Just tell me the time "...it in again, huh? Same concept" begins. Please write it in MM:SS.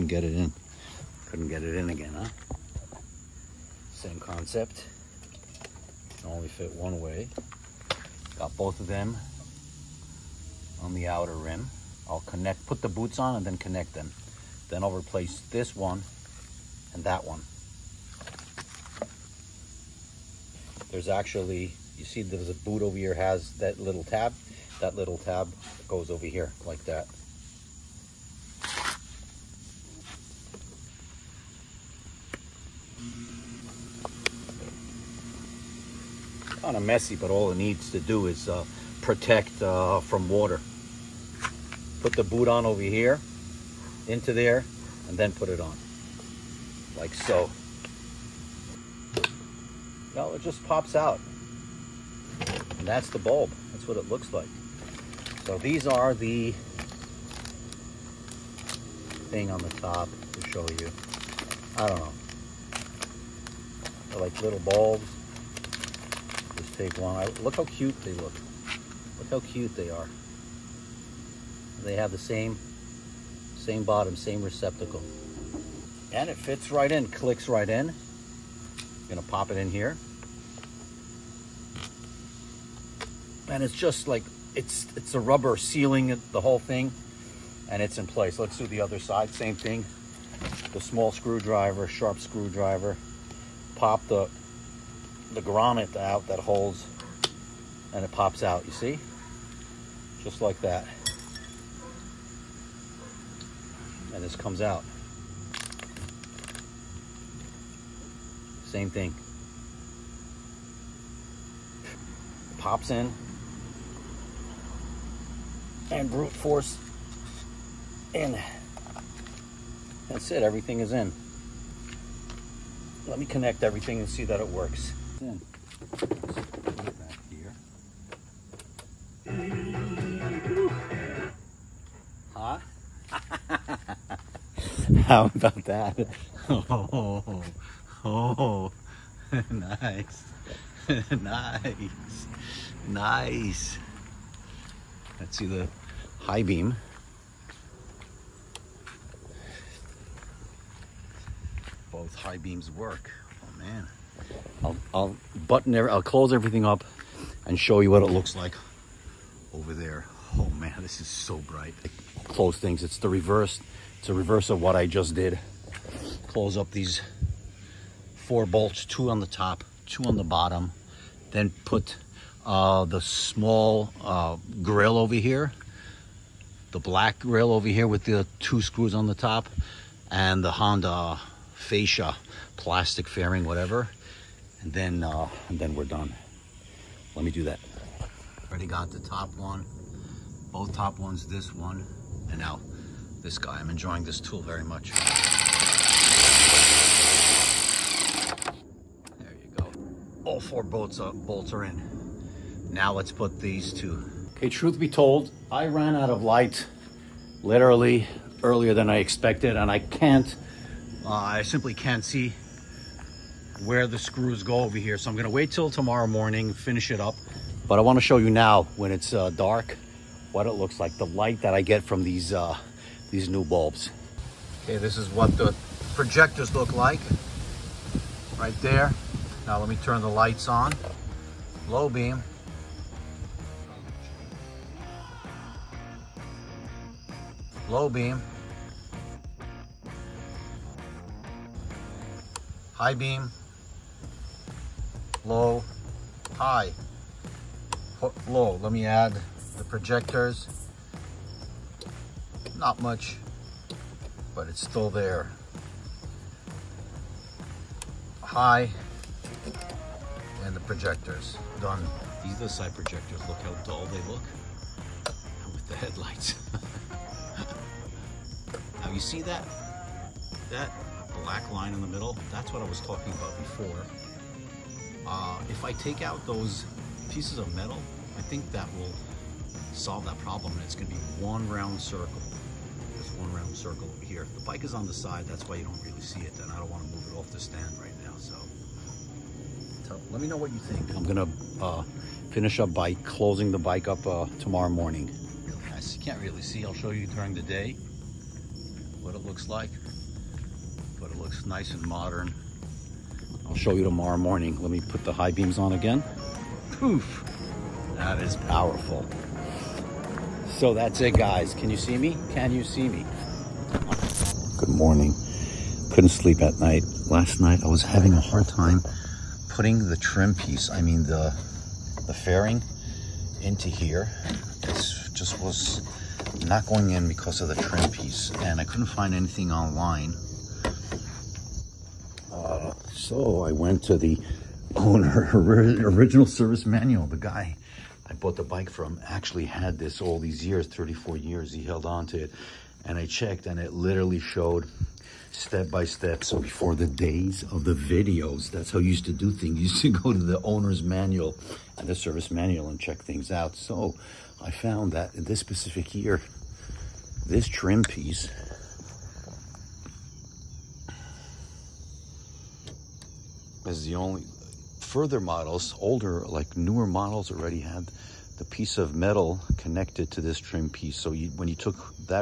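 00:01.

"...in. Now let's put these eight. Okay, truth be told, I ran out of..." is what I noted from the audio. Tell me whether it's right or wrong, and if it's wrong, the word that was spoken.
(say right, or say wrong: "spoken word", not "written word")
wrong: "two", not "eight".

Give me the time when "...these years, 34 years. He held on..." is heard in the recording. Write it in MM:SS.
05:40.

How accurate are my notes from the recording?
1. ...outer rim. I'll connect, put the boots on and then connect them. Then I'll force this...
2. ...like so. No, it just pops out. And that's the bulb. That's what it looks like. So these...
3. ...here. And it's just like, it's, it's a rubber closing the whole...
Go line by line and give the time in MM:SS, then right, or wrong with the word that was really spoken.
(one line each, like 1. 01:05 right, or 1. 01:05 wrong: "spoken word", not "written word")
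1. 00:11 wrong: "replace", not "force"
2. 00:46 right
3. 01:19 wrong: "sealing", not "closing".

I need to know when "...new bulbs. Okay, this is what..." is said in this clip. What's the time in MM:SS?
03:43.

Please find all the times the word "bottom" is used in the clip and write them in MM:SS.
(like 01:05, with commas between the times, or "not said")
01:13, 02:50.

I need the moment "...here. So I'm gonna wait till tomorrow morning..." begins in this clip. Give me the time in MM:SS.
03:34.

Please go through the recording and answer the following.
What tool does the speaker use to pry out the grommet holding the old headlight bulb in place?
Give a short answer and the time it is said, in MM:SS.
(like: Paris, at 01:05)
small screwdriver, at 01:30.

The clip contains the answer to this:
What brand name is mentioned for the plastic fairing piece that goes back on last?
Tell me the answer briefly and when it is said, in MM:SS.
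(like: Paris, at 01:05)
Honda, at 03:00.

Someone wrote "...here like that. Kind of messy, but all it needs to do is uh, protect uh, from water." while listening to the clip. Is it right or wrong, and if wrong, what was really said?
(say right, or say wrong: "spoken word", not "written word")
right.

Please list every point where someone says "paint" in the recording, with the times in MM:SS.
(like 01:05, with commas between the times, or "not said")
not said.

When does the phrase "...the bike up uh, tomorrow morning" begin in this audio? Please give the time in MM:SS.
04:53.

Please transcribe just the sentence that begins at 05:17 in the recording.
Last night I was having a hard time putting the trim piece, I mean the, the fairing, into here.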